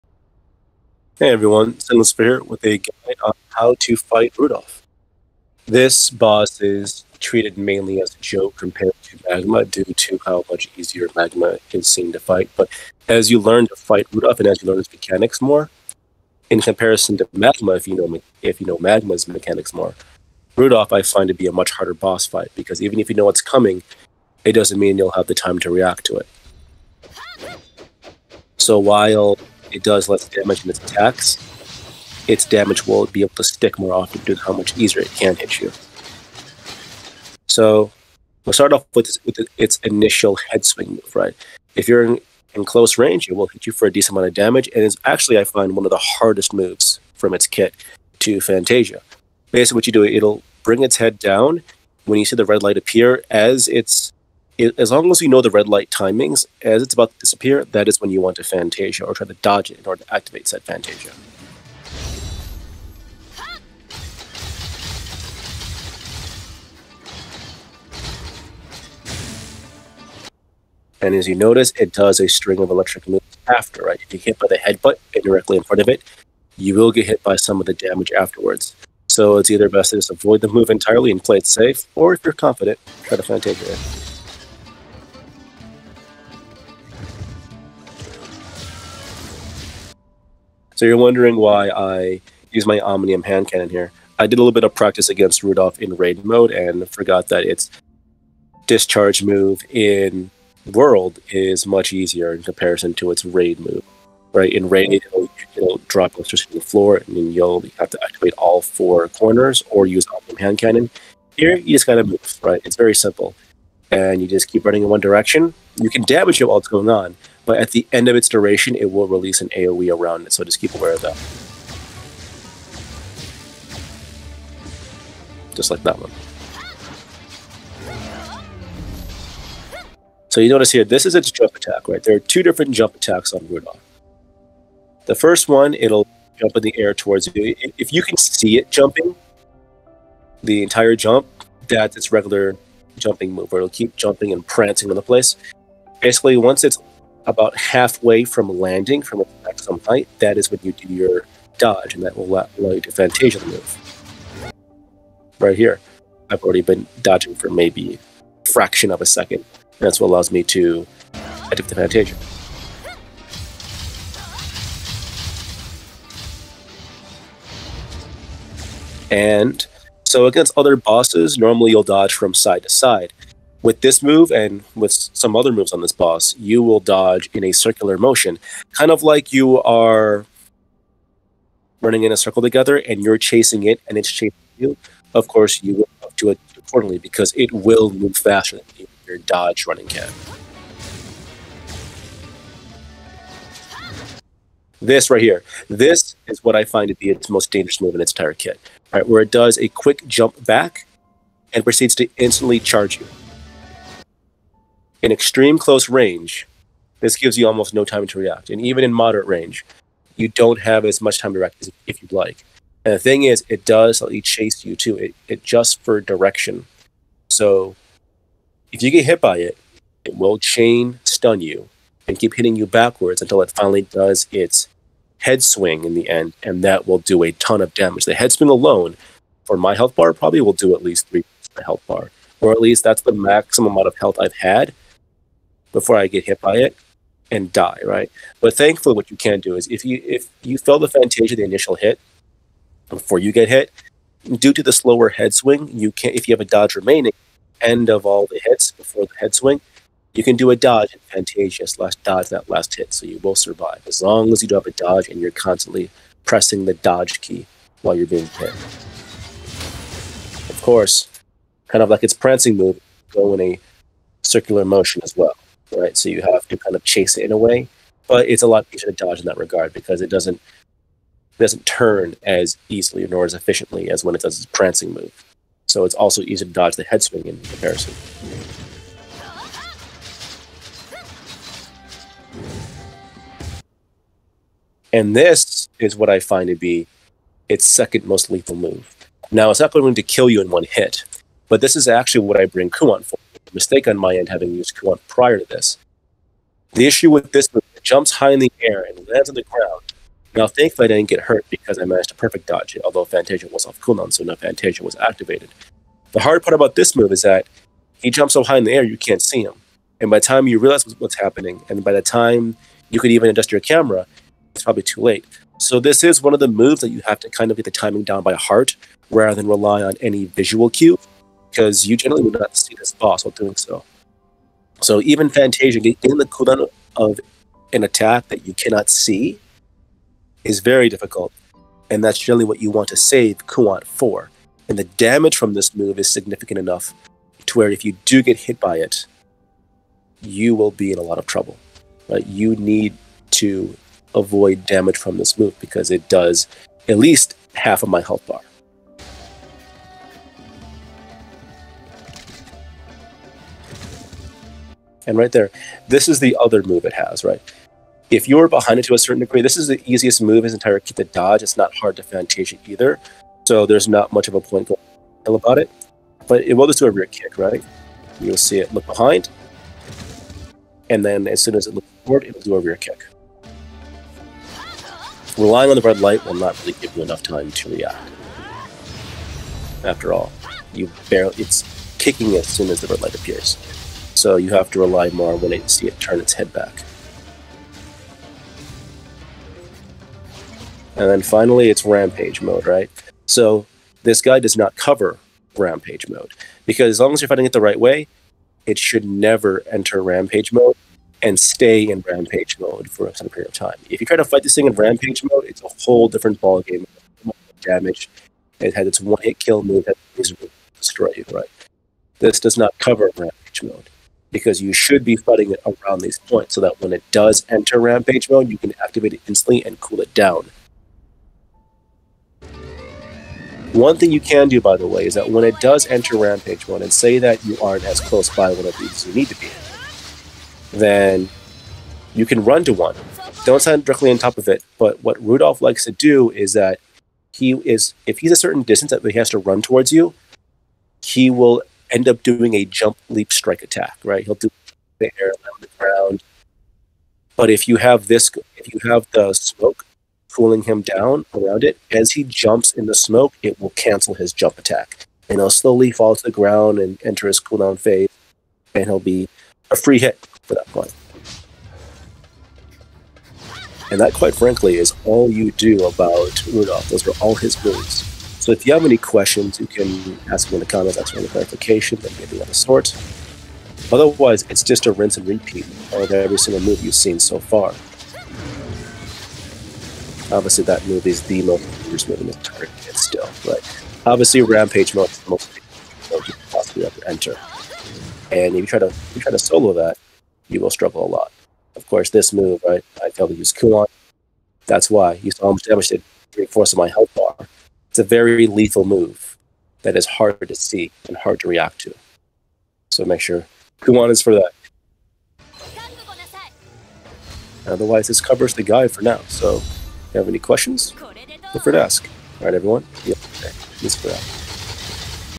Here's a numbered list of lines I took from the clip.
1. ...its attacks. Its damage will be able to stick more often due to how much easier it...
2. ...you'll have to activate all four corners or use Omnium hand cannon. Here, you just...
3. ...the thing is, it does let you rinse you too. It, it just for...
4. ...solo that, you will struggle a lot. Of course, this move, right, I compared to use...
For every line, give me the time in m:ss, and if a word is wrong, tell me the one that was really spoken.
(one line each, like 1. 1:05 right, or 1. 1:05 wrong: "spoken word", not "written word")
1. 0:30 right
2. 1:47 right
3. 3:32 wrong: "chase", not "rinse"
4. 8:09 wrong: "failed", not "compared".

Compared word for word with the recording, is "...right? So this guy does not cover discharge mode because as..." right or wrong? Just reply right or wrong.
wrong.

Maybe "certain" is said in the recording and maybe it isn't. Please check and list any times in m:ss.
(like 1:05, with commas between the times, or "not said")
5:58, 6:43, 7:18.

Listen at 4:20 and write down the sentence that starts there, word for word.
Of course, kind of like its prancing move, go in a circular motion as well right?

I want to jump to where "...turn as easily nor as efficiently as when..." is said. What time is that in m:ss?
4:31.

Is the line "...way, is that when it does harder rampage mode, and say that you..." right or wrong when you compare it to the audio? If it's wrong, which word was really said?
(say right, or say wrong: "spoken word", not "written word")
wrong: "enter", not "harder".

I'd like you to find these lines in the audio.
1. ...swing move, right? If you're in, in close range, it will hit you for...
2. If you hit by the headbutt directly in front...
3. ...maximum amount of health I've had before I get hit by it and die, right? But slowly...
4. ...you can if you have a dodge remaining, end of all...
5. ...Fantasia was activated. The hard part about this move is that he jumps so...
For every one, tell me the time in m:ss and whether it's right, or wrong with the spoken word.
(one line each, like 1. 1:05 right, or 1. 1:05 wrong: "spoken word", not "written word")
1. 0:40 right
2. 1:14 right
3. 3:53 wrong: "thankfully", not "slowly"
4. 4:05 right
5. 5:04 right.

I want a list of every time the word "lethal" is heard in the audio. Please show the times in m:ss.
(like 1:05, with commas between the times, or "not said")
4:48, 8:18.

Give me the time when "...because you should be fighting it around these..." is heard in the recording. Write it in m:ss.
6:54.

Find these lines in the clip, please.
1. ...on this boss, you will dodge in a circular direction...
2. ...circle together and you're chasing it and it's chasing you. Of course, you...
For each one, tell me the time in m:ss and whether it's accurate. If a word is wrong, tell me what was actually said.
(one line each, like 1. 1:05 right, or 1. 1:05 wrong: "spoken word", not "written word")
1. 2:55 wrong: "motion", not "direction"
2. 3:02 right.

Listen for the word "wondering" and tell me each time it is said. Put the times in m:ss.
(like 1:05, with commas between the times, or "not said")
1:30.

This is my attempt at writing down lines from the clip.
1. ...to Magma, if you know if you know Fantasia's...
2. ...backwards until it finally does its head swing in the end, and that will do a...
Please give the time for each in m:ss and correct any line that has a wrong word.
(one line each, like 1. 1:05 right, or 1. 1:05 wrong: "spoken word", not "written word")
1. 0:17 wrong: "Magma", not "Fantasia"
2. 3:42 right.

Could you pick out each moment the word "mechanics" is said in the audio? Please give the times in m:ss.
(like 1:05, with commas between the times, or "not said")
0:14, 0:19.